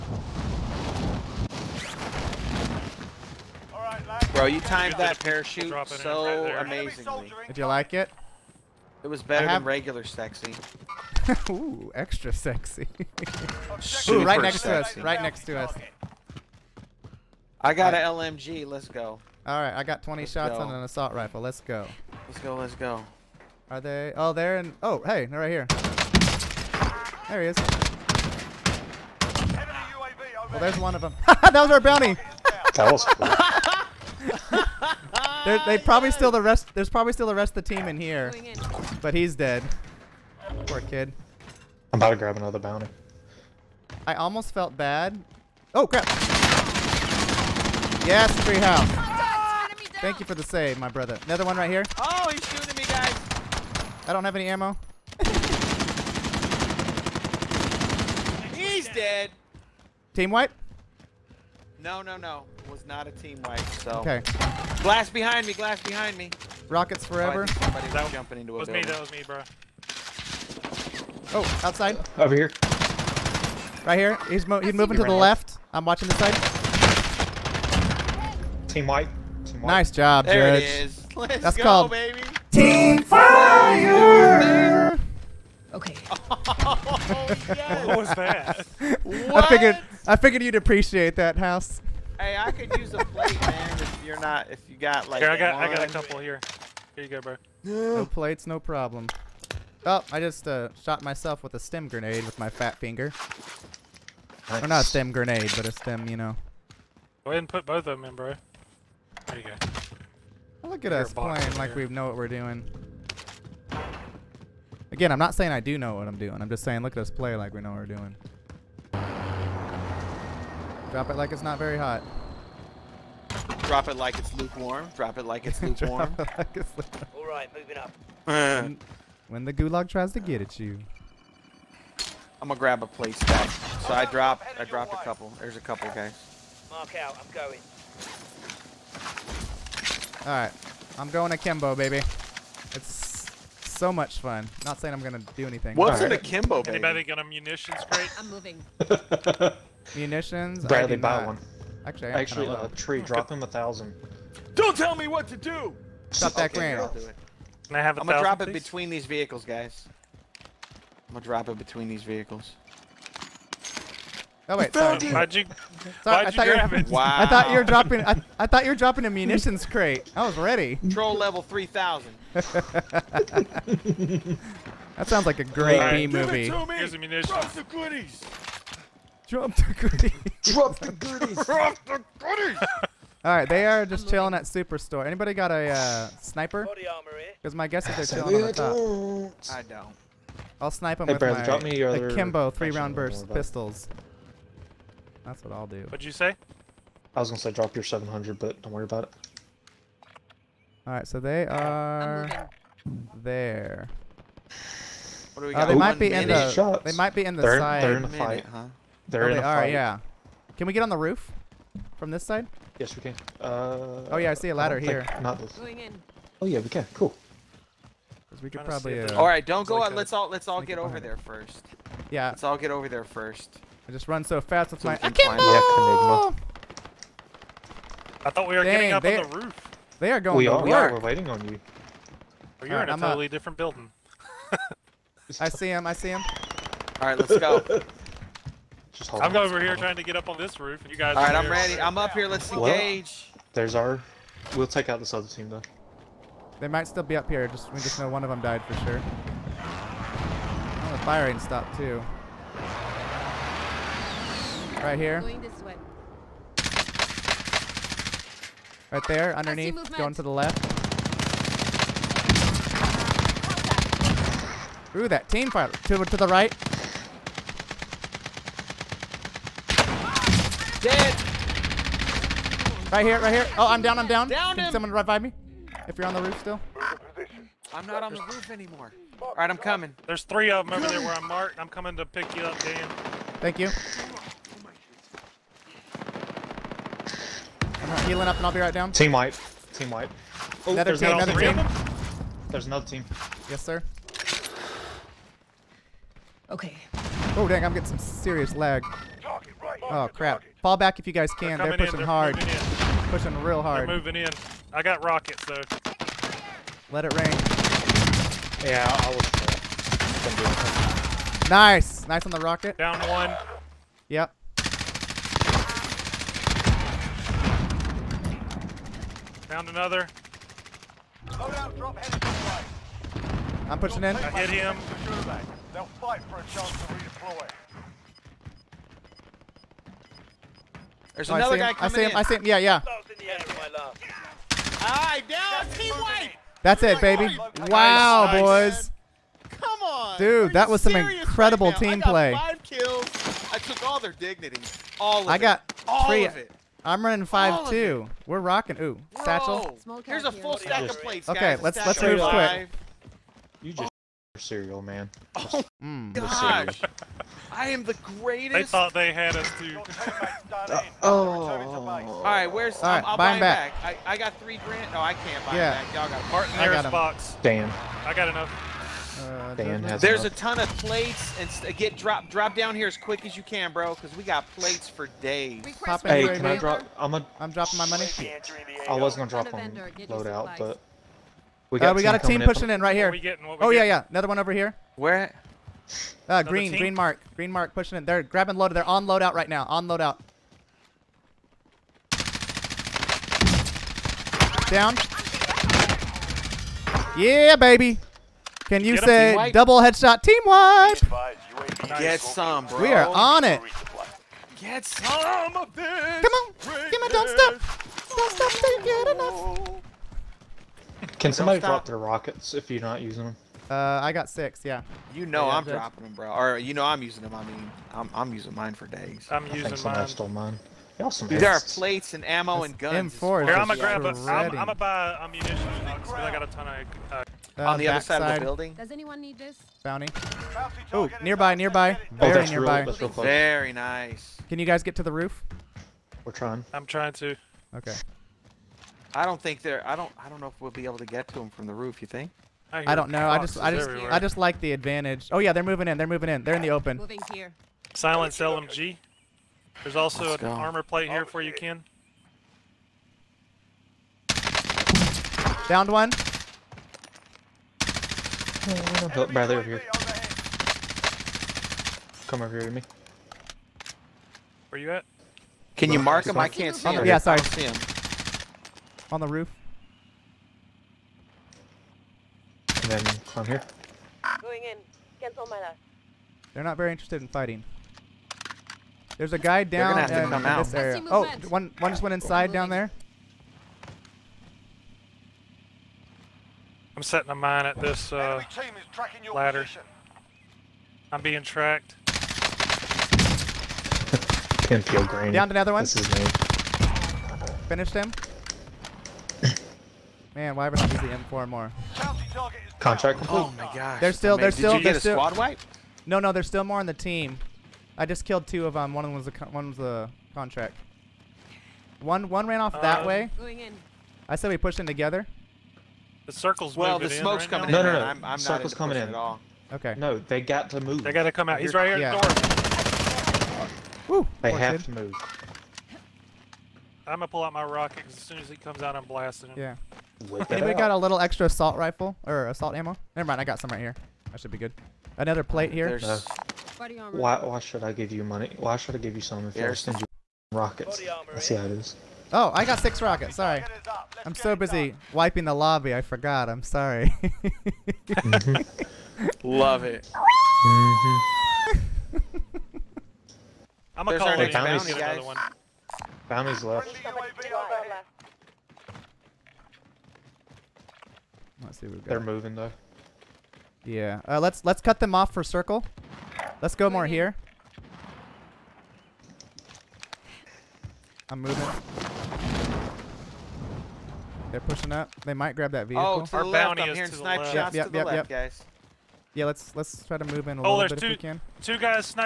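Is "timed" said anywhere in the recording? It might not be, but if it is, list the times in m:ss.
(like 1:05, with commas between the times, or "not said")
0:04.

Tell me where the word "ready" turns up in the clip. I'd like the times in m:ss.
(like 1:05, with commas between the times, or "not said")
2:50, 4:01.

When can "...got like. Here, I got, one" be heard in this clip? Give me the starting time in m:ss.
1:34.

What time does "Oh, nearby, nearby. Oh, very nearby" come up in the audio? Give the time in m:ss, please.
7:10.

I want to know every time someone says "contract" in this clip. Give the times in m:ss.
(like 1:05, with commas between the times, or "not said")
8:22, 8:30.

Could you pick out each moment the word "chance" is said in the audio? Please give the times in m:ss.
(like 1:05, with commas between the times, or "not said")
5:26.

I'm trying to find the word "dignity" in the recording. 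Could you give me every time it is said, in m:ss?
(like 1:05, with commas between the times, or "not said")
5:44.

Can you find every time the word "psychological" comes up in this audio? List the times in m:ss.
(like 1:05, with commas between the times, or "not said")
not said.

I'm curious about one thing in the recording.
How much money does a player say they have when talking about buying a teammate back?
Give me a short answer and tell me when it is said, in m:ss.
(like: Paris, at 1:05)
3 grand, at 6:04.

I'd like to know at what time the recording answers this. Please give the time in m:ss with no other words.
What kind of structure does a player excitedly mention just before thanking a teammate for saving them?
0:48.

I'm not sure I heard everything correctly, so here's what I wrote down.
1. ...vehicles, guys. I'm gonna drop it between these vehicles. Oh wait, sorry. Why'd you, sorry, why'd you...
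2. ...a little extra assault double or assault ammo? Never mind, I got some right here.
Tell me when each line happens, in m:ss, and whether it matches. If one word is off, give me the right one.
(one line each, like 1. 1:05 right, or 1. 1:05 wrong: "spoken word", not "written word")
1. 2:39 right
2. 8:50 wrong: "rifle", not "double".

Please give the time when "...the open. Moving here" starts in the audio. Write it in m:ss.
7:26.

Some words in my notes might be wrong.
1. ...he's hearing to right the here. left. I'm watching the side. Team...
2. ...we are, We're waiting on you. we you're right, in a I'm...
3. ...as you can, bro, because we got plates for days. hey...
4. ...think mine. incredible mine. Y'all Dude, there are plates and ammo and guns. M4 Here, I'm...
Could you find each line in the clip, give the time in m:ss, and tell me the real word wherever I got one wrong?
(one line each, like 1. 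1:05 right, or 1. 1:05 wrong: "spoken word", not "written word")
1. 1:14 wrong: "moving", not "hearing"
2. 3:50 right
3. 6:13 right
4. 6:59 wrong: "stole", not "incredible".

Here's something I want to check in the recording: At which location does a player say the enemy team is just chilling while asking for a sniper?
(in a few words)
Superstore.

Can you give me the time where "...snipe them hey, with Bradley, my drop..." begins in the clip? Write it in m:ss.
3:10.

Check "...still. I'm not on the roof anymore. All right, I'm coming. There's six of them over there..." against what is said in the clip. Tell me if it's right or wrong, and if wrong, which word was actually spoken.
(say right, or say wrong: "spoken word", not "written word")
wrong: "three", not "six".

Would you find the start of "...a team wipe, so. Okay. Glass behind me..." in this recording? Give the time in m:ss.
1:03.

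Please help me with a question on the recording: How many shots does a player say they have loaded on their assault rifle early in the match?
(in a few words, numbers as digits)
20.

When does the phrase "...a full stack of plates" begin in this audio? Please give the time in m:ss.
5:50.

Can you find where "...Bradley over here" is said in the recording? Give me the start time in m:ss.
7:39.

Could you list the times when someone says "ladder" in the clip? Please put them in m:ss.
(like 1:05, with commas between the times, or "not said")
3:34, 8:09.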